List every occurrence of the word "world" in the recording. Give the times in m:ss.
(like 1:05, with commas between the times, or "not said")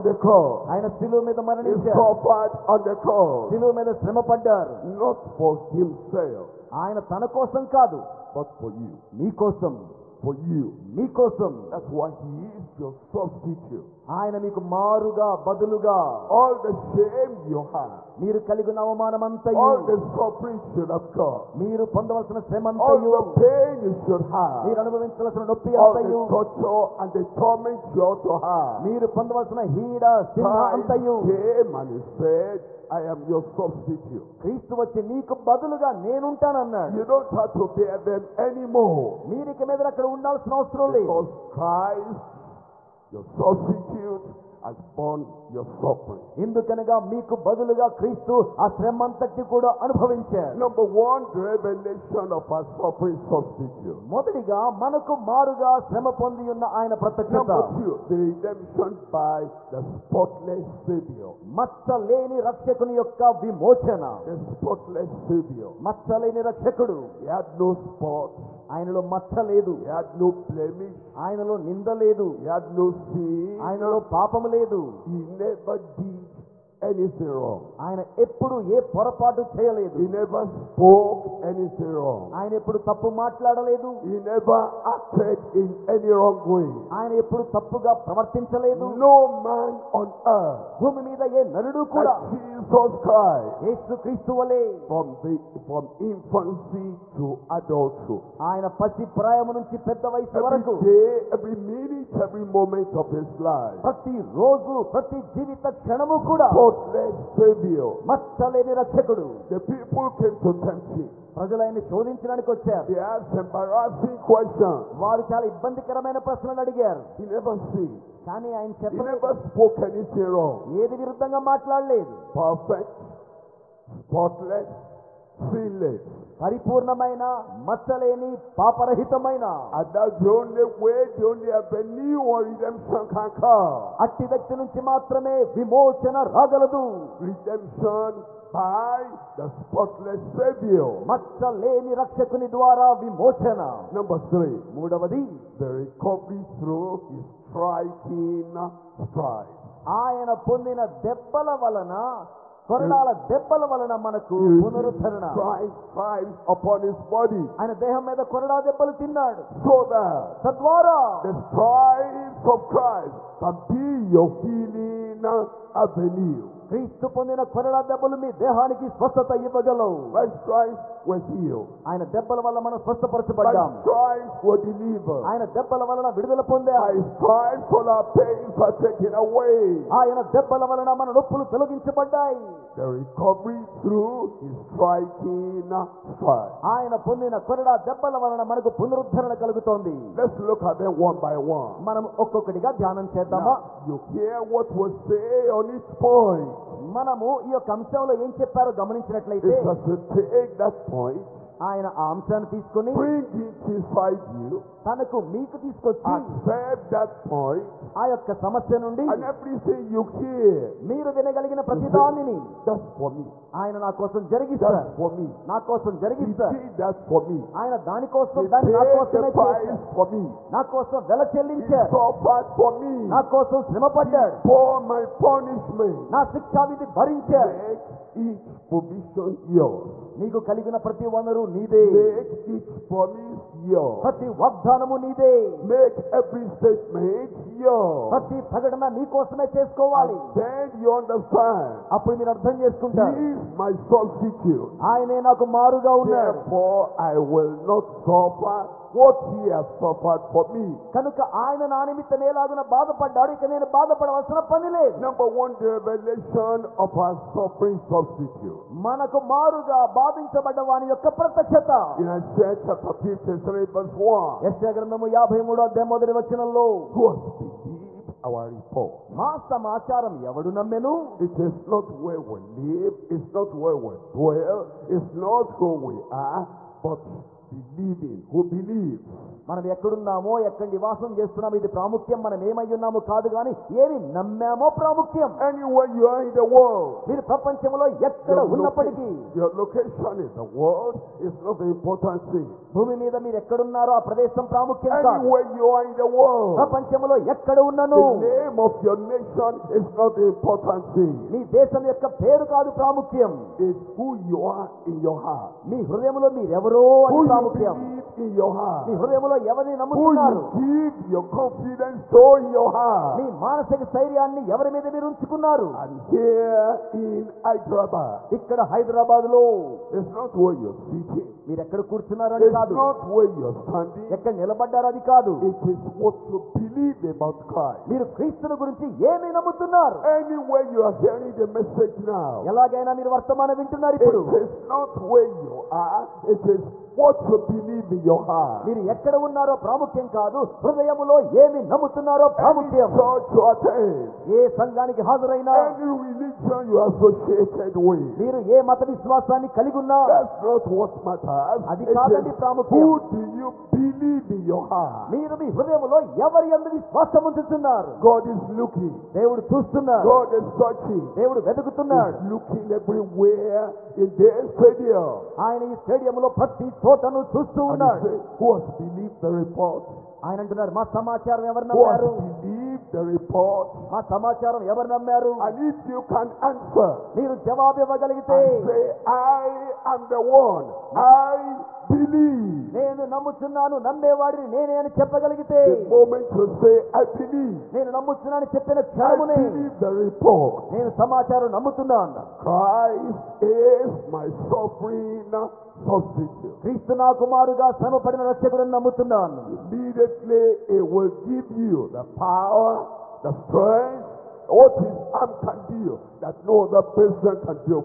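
4:46, 4:50, 4:56.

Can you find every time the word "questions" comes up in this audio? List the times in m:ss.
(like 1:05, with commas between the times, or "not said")
1:54.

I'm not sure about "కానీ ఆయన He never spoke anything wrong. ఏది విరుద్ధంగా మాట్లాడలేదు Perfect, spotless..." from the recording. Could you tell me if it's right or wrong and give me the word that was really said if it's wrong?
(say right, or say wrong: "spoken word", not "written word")
right.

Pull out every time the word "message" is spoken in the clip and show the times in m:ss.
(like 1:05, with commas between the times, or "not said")
5:31.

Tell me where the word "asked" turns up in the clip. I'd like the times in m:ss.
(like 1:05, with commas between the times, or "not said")
1:53.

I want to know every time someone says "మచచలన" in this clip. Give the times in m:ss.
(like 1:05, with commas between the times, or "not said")
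1:01, 1:05, 1:48, 2:07, 2:21.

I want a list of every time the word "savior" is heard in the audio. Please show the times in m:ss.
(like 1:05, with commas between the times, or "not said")
1:00, 1:47, 2:20.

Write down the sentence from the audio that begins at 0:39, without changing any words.
మీరు ఇక మీద అక్కడ ఉండాల్సిన అవసరం లేదు.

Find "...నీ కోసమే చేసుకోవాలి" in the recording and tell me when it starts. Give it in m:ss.
3:58.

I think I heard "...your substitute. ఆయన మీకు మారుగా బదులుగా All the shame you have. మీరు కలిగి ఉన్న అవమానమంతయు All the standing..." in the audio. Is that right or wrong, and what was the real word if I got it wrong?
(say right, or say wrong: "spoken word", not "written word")
wrong: "suffering", not "standing".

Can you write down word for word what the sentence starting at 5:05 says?
మీ హృదయంలో మీరెవరో అది Who you ప్రాముఖ్యం believe in your heart.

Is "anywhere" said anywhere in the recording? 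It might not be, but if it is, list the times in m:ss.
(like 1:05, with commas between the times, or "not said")
4:45, 4:55, 5:30.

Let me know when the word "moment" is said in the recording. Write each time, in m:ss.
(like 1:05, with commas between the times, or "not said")
1:42, 6:23.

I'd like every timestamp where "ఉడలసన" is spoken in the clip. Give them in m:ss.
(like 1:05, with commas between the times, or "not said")
0:40.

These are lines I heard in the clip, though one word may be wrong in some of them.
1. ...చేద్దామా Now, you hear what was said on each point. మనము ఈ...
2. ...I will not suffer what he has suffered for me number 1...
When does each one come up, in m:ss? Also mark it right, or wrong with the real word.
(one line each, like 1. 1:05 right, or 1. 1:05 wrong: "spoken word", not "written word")
1. 3:13 right
2. 4:06 right.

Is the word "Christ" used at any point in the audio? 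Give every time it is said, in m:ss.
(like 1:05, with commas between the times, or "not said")
0:29, 0:41, 1:34, 2:42, 5:27, 6:32.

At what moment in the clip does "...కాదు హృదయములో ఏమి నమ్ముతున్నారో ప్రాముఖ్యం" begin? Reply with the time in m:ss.
5:40.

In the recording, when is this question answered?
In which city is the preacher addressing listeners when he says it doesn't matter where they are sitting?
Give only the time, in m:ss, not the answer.
5:16.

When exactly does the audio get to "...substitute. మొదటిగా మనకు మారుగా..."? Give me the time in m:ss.
0:53.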